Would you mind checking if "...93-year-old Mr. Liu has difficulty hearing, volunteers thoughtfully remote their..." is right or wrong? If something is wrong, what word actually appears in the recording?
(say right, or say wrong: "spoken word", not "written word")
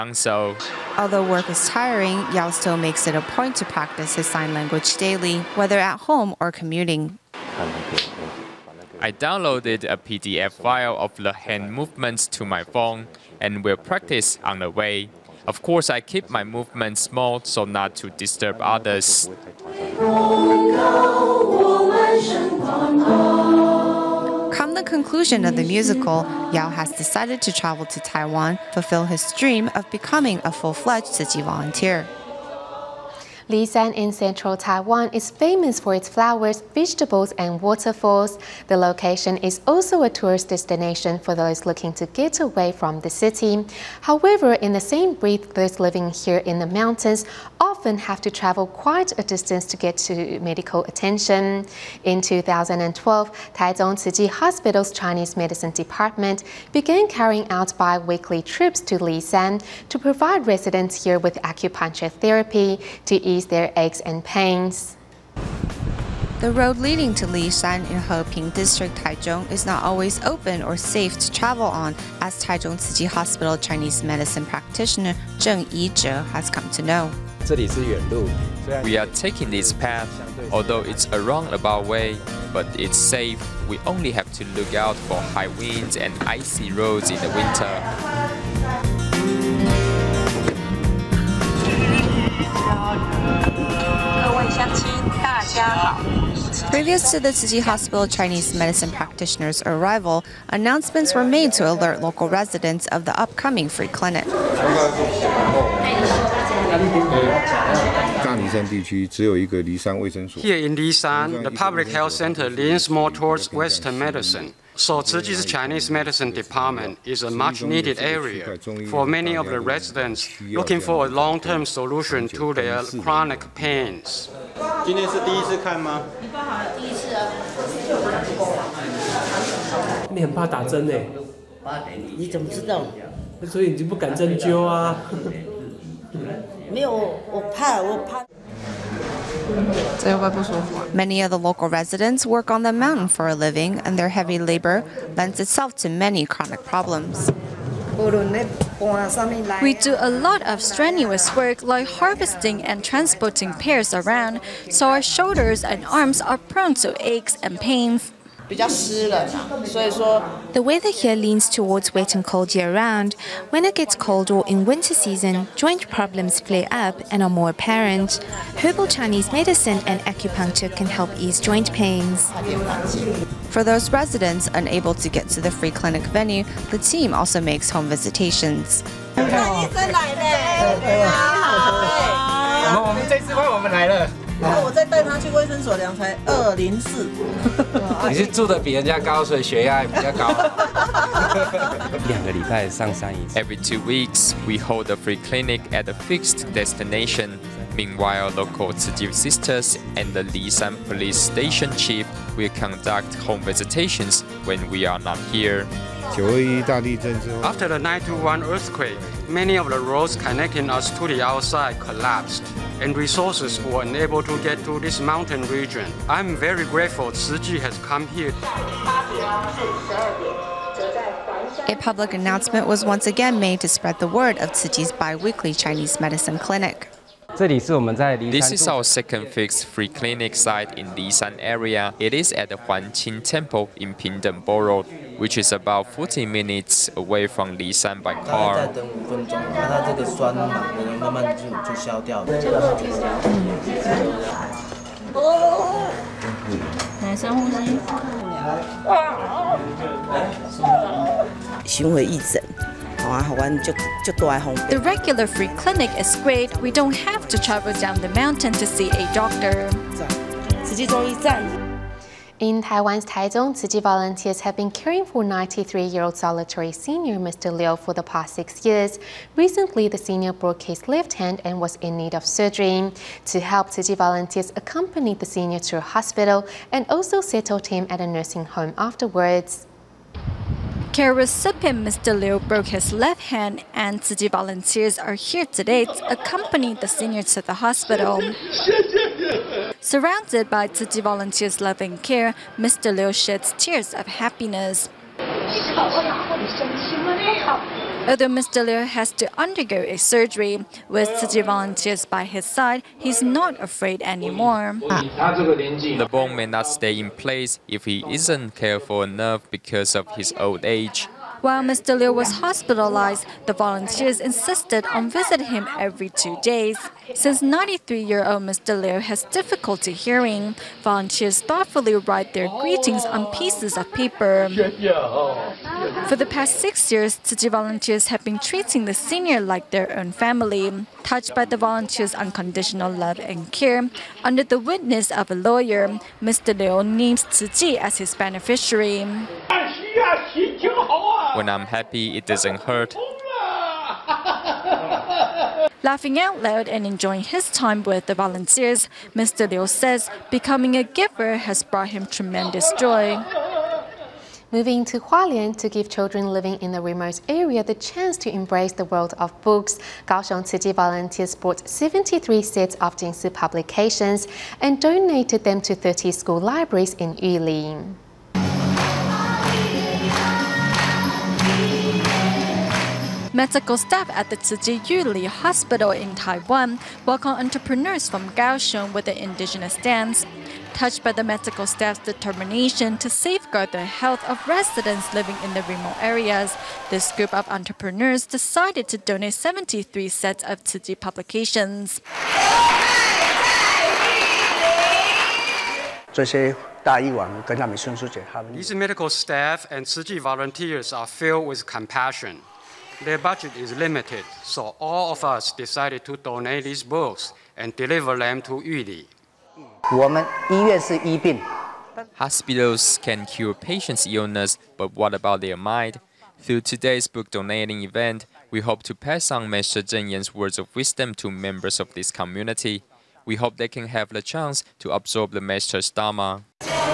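wrong: "write", not "remote".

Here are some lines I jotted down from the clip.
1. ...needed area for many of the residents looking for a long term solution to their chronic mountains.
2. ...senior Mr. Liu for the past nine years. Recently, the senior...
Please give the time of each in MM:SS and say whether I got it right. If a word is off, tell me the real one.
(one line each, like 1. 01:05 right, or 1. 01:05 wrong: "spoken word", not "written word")
1. 01:57 wrong: "pains", not "mountains"
2. 04:26 wrong: "six", not "nine".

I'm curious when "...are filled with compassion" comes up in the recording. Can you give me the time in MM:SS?
06:40.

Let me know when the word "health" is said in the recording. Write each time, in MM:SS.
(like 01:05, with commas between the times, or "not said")
01:51, 06:23.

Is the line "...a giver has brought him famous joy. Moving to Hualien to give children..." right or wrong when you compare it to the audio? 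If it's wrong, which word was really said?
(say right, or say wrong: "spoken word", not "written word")
wrong: "tremendous", not "famous".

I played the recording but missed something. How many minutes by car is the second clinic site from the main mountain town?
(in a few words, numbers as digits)
40.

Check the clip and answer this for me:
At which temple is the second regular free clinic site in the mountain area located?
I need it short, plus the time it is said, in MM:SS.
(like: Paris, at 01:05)
Huanqing Temple, at 03:52.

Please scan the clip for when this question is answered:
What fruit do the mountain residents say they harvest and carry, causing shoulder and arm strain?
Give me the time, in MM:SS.
02:33.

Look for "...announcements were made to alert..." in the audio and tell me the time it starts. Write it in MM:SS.
01:40.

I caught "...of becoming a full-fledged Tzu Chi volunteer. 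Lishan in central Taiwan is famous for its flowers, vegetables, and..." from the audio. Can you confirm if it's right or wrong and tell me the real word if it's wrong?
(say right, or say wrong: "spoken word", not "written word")
right.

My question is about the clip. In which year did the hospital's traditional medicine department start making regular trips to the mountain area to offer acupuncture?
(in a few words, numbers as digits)
2012.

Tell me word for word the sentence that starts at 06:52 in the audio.
Hospitals can cure patients' illness, but what about their mind?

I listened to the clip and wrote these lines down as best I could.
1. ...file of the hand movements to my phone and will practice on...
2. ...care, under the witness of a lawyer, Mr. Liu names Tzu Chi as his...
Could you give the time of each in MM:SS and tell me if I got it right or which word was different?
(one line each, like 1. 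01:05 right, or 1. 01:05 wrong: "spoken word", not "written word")
1. 00:10 right
2. 05:33 right.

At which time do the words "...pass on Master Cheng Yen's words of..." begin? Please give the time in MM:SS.
06:58.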